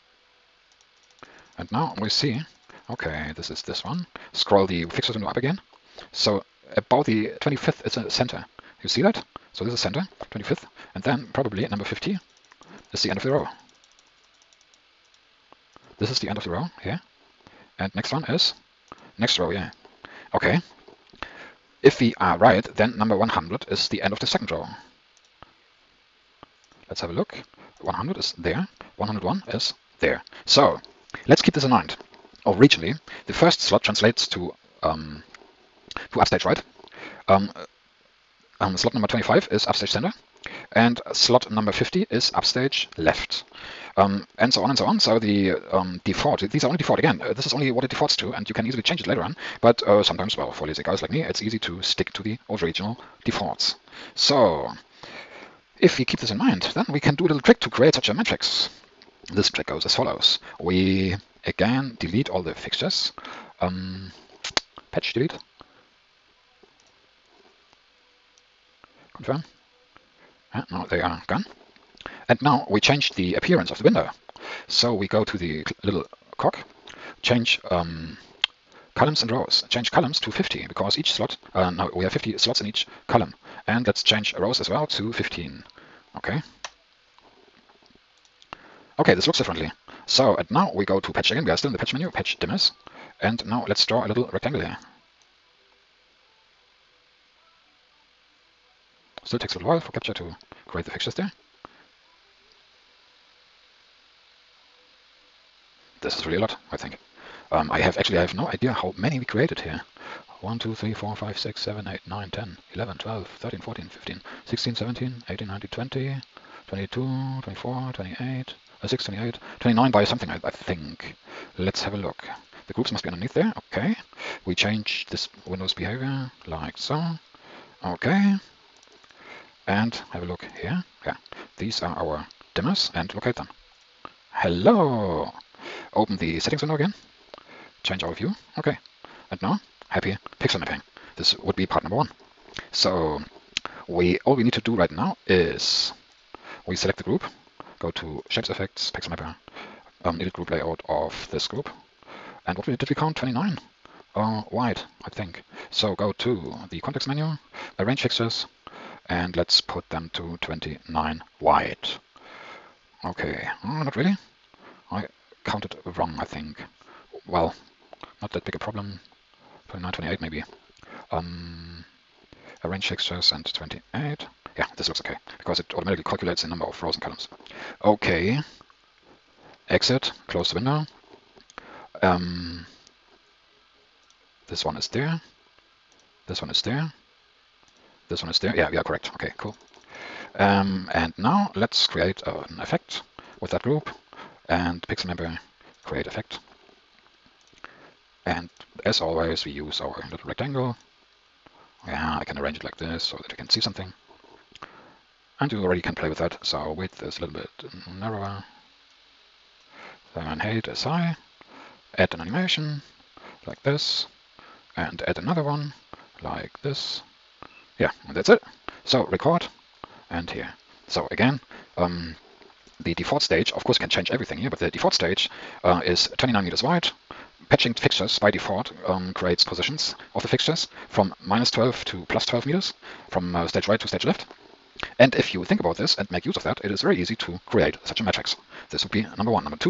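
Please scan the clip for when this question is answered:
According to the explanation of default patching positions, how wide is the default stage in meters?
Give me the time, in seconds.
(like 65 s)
226 s.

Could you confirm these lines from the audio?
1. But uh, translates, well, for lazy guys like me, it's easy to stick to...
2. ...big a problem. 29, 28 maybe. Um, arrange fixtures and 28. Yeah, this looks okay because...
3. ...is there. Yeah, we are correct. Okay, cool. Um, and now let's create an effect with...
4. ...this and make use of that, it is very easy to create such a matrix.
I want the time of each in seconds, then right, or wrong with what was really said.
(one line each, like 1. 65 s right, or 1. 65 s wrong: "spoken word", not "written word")
1. 49 s wrong: "sometimes", not "translates"
2. 168 s right
3. 188 s right
4. 235 s right.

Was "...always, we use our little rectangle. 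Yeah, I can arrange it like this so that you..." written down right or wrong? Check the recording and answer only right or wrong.
right.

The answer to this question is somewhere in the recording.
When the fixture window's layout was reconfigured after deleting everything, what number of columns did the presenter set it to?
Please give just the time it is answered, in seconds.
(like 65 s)
79 s.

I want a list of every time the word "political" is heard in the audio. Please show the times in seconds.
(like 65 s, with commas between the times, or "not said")
not said.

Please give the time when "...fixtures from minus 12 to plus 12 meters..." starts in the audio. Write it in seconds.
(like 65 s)
230 s.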